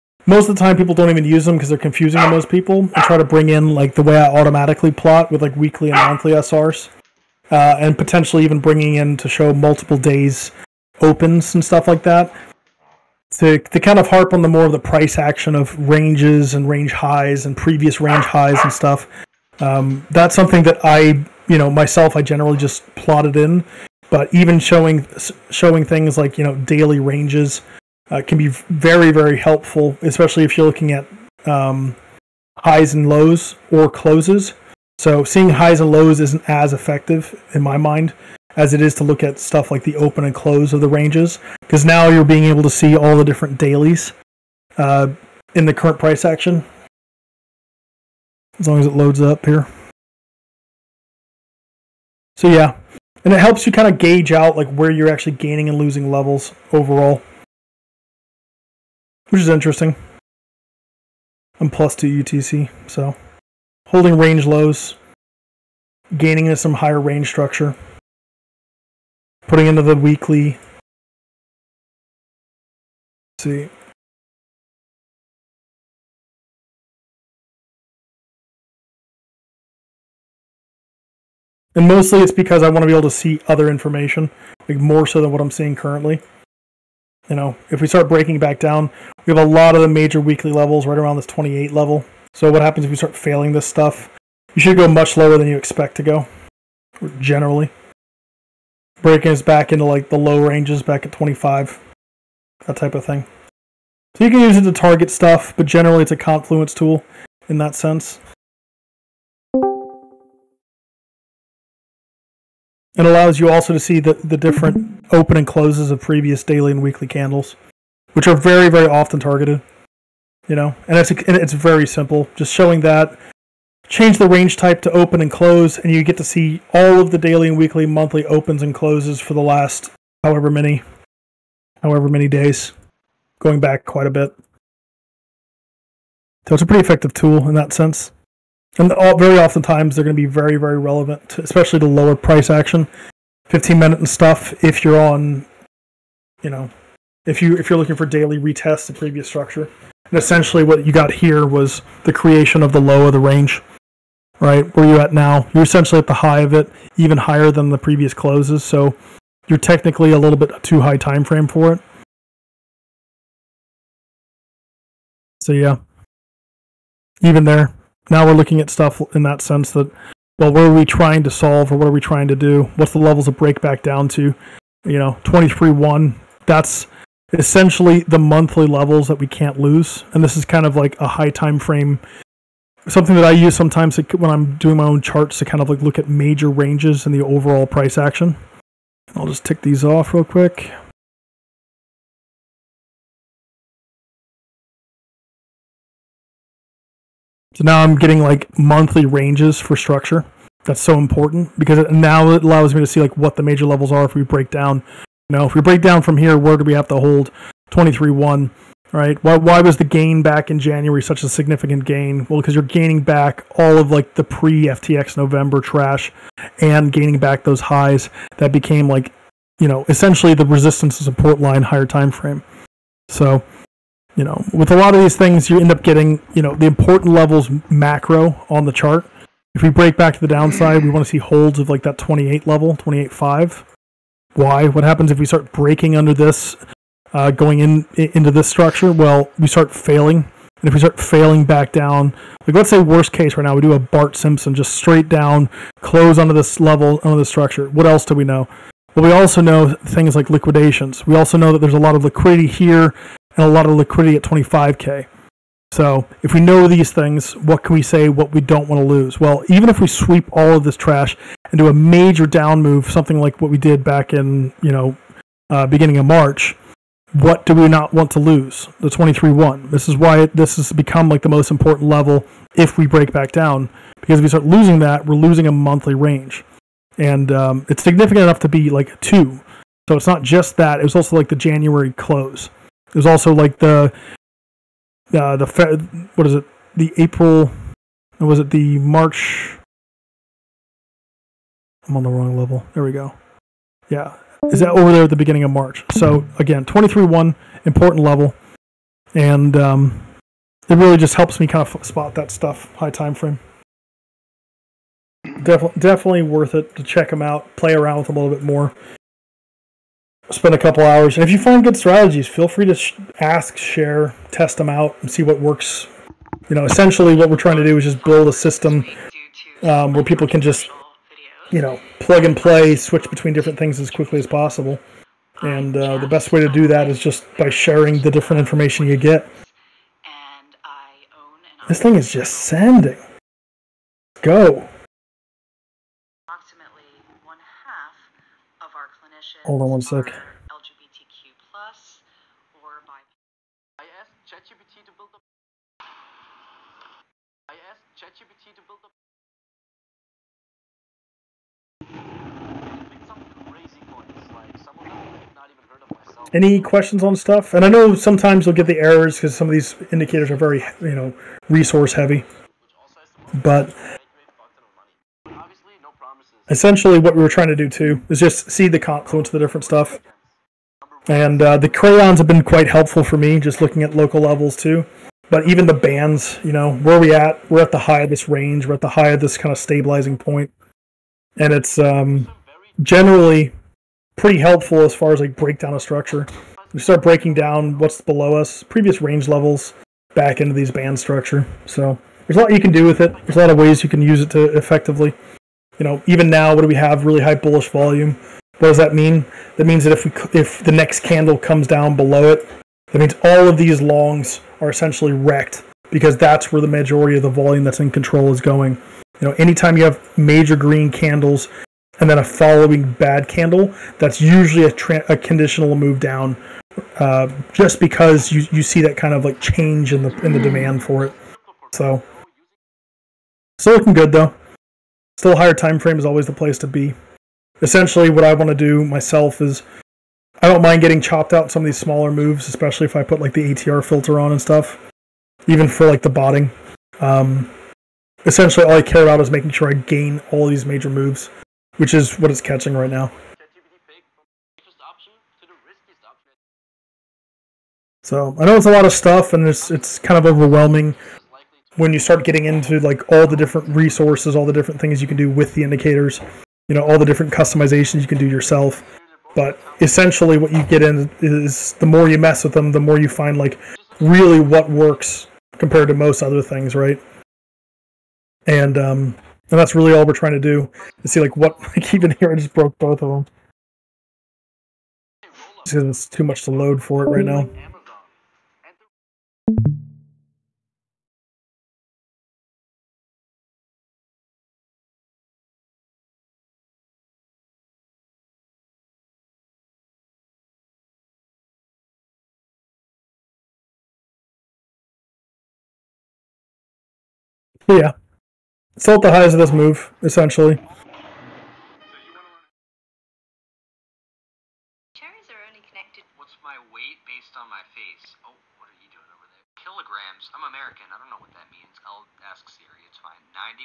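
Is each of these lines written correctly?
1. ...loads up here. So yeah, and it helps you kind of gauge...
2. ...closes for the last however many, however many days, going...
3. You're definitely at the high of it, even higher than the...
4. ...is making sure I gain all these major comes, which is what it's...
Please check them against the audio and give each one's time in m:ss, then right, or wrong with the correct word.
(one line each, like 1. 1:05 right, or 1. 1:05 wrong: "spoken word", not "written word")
1. 0:48 right
2. 2:08 right
3. 2:35 wrong: "essentially", not "definitely"
4. 7:19 wrong: "moves", not "comes".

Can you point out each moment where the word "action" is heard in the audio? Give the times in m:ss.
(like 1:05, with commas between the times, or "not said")
0:15, 0:46, 2:22, 3:07.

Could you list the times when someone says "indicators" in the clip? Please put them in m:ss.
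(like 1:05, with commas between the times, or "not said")
5:59, 7:35.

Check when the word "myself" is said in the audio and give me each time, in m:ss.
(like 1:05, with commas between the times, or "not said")
0:21, 7:08.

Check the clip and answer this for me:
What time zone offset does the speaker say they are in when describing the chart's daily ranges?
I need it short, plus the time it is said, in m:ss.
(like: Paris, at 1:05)
+2 UTC, at 1:01.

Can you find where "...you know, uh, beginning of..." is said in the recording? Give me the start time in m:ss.
4:24.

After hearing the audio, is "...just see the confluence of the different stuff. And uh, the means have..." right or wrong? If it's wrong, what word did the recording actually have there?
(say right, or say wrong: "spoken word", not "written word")
wrong: "crayons", not "means".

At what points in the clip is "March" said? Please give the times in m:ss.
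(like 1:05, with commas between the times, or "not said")
4:26, 4:48, 4:55.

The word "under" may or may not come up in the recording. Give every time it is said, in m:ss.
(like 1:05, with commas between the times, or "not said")
3:55, 4:07.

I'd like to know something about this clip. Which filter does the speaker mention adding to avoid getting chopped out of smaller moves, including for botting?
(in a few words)
ATR filter.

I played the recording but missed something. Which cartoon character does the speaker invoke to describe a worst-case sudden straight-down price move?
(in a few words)
Bart Simpson.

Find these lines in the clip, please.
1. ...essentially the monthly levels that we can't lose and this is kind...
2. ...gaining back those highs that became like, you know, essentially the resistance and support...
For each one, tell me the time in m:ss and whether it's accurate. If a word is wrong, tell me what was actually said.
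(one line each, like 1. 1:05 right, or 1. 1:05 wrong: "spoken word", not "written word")
1. 2:57 right
2. 3:36 right.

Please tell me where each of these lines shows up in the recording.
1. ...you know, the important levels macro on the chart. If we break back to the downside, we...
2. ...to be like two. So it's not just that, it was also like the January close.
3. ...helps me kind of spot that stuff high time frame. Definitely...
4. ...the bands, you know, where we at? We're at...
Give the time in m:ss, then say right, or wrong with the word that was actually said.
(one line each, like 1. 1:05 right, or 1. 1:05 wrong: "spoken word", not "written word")
1. 3:46 right
2. 4:38 right
3. 5:01 right
4. 6:15 right.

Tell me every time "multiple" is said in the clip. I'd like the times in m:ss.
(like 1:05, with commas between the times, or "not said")
0:09.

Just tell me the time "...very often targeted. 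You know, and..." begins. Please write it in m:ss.
1:58.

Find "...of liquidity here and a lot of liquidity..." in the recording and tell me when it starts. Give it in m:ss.
4:11.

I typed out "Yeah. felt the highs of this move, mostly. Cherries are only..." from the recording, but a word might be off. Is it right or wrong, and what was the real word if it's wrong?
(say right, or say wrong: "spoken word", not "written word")
wrong: "essentially", not "mostly".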